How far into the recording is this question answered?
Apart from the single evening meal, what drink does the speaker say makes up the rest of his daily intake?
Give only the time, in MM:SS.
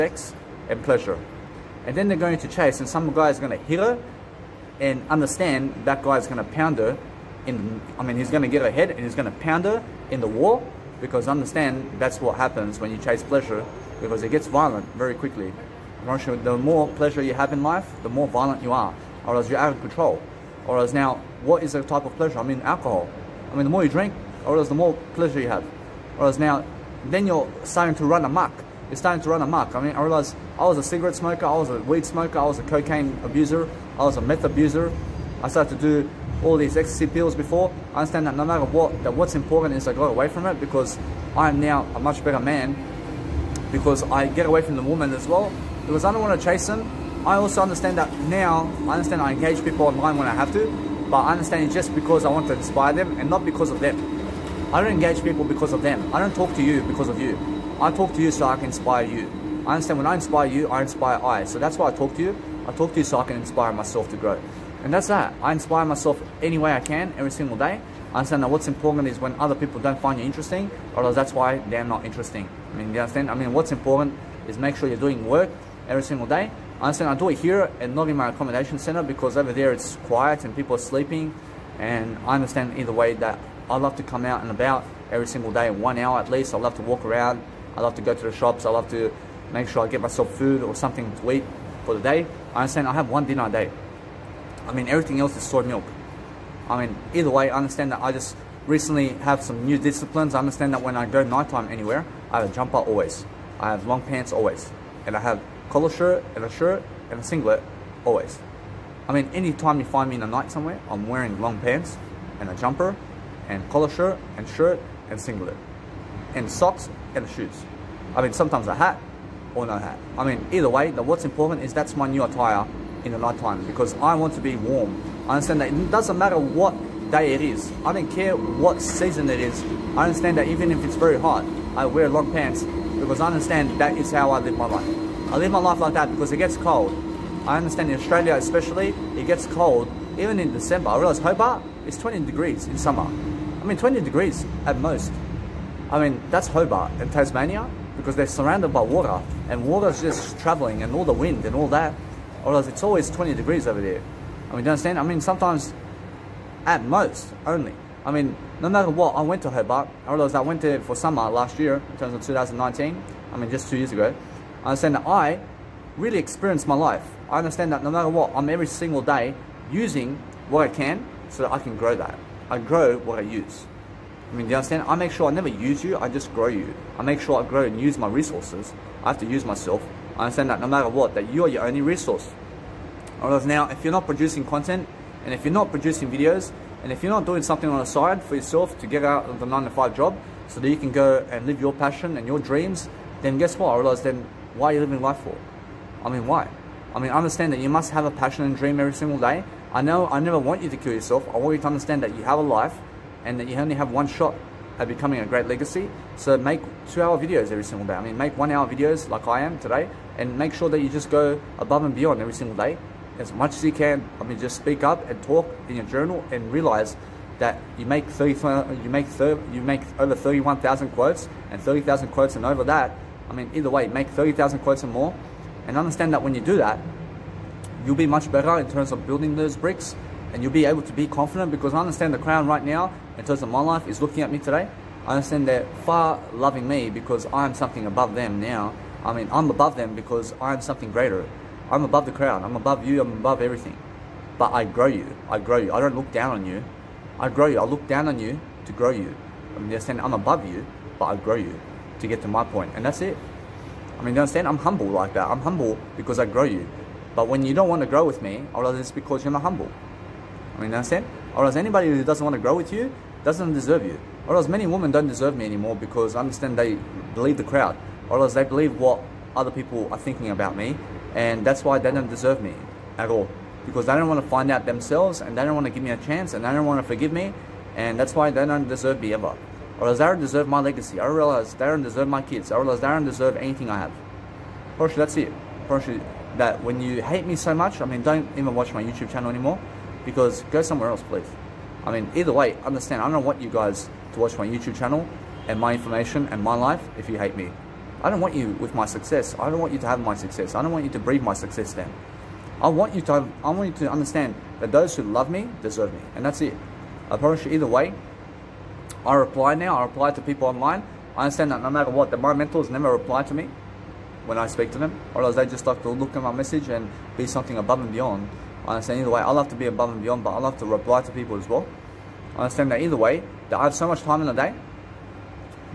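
01:35.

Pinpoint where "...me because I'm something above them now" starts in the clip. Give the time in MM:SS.
03:56.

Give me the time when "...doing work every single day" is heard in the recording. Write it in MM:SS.
01:14.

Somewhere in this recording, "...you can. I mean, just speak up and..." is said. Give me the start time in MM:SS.
03:33.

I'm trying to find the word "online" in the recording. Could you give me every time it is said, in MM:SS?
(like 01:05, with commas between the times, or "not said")
00:49, 05:10.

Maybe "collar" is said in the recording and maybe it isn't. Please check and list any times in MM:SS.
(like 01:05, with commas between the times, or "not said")
01:45, 01:53.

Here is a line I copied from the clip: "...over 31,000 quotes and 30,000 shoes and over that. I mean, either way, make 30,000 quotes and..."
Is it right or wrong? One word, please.
wrong.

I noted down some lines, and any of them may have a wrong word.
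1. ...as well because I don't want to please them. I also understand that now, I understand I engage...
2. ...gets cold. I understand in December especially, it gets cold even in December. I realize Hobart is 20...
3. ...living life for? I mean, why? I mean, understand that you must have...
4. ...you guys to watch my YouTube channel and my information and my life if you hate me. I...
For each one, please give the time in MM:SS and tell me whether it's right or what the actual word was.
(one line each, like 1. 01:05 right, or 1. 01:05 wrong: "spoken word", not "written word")
1. 00:45 wrong: "chase", not "please"
2. 02:16 wrong: "Australia", not "December"
3. 03:14 right
4. 04:53 right.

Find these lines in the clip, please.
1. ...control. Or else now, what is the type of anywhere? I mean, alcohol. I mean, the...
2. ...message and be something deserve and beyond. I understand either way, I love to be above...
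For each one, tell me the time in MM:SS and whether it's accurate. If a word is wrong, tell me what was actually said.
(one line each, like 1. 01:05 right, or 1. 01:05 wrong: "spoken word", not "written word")
1. 00:19 wrong: "pleasure", not "anywhere"
2. 05:16 wrong: "above", not "deserve".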